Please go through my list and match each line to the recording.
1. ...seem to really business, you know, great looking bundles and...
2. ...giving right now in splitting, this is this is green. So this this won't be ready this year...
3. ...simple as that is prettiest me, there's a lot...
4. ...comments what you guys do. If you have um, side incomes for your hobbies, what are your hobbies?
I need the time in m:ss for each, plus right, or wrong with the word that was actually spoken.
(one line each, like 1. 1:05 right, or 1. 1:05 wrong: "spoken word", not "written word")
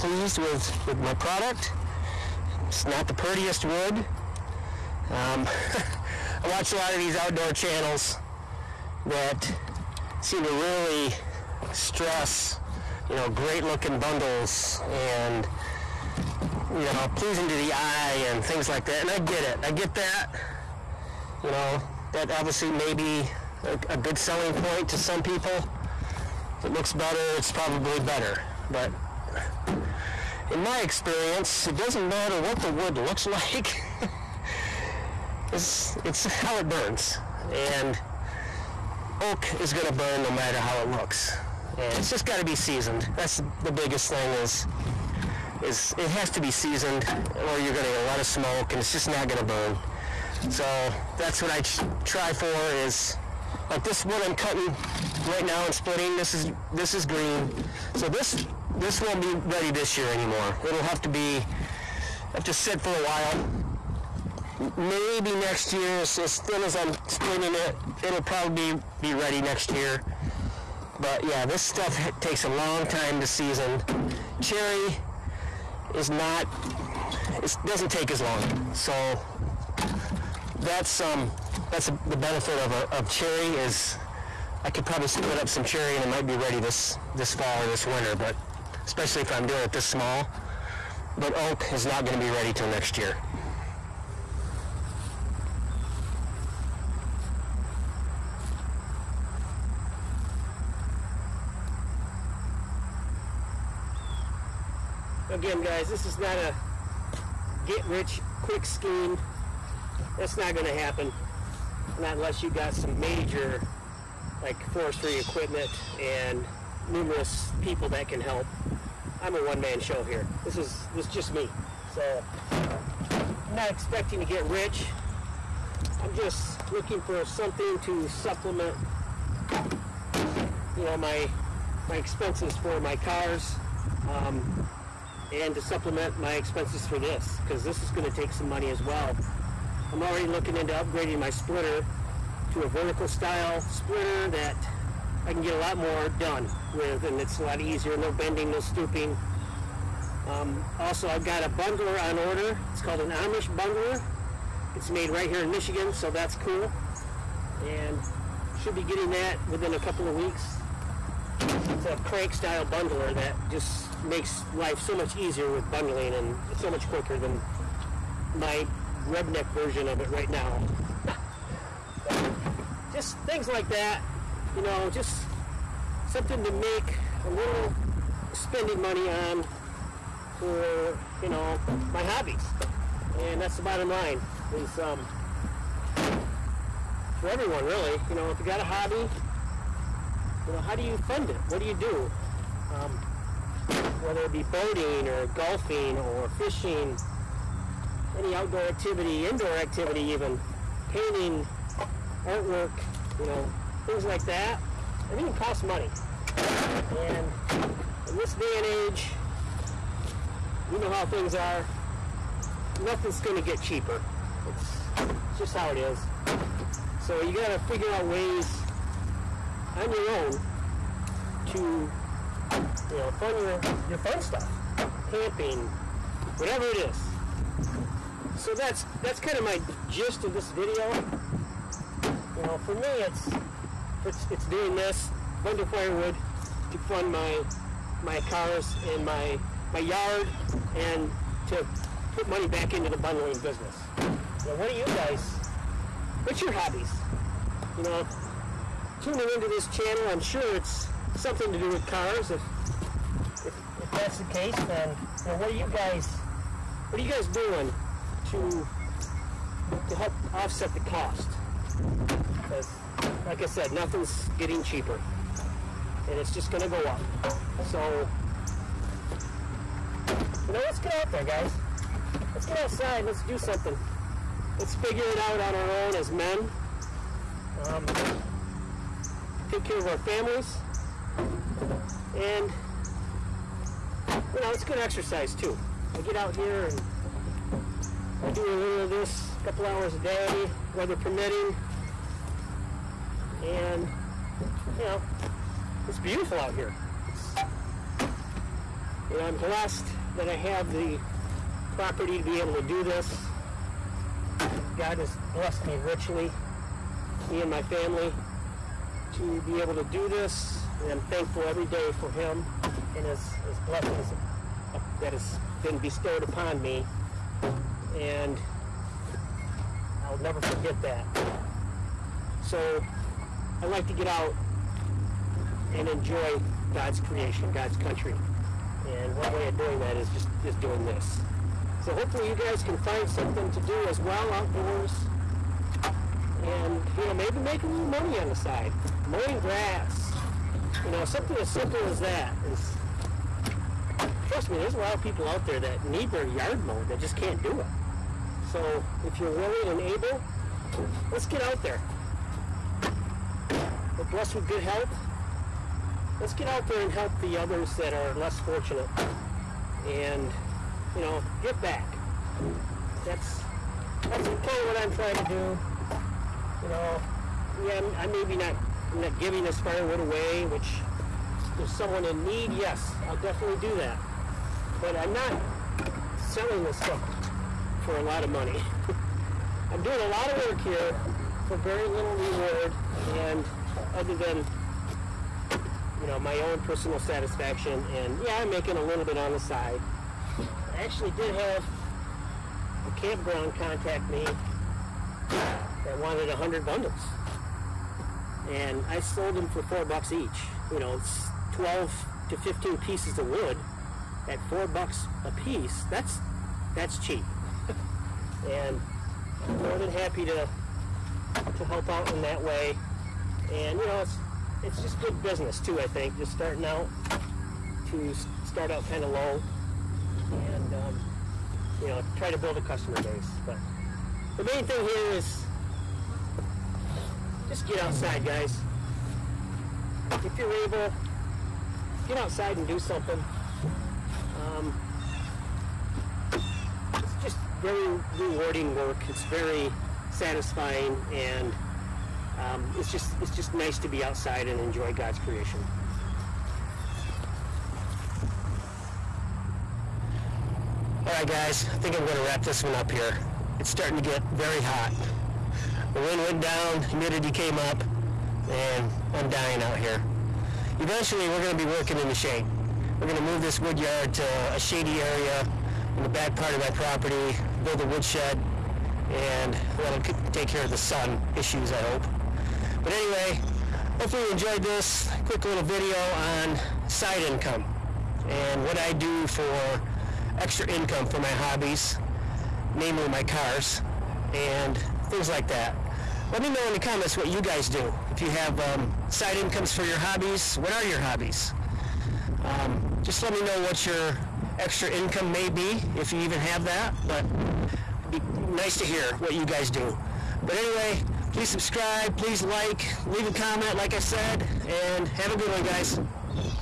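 1. 0:10 wrong: "stress", not "business"
2. 0:54 wrong: "cutting", not "giving"
3. 5:41 wrong: "trust", not "prettiest"
4. 8:06 right.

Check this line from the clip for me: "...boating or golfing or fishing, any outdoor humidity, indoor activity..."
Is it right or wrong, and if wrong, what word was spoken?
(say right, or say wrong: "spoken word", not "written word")
wrong: "activity", not "humidity".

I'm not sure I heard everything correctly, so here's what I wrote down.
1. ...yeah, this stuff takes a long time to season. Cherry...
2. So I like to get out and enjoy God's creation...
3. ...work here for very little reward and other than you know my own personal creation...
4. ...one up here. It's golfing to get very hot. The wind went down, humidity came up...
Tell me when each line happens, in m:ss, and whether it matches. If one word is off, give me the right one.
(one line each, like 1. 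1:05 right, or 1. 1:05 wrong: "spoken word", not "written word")
1. 1:11 right
2. 5:22 right
3. 6:20 wrong: "satisfaction", not "creation"
4. 7:32 wrong: "starting", not "golfing".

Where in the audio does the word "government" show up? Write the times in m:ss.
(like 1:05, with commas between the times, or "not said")
not said.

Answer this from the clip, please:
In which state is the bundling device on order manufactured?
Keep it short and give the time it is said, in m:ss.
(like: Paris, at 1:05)
Michigan, at 2:35.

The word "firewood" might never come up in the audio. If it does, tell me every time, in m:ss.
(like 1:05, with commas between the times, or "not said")
3:55, 6:09.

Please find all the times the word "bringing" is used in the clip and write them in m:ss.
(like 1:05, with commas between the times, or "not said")
not said.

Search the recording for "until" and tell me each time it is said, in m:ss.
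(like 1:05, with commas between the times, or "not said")
not said.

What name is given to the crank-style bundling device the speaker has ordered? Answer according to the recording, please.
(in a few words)
Amish bundler.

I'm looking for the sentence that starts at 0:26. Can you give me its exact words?
If it looks better, it's probably better.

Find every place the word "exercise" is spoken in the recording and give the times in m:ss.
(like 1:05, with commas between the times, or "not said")
4:44.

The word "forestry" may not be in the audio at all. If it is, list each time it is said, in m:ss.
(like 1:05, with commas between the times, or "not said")
1:54.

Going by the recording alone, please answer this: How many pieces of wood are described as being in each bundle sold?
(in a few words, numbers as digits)
12 to 15.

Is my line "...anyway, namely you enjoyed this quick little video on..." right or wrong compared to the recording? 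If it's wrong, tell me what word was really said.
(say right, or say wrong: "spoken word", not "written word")
wrong: "hopefully", not "namely".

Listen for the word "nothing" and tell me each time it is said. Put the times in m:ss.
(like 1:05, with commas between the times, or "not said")
3:32, 4:23.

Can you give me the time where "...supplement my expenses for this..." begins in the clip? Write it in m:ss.
2:15.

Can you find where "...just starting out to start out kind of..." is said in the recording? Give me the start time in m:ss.
6:56.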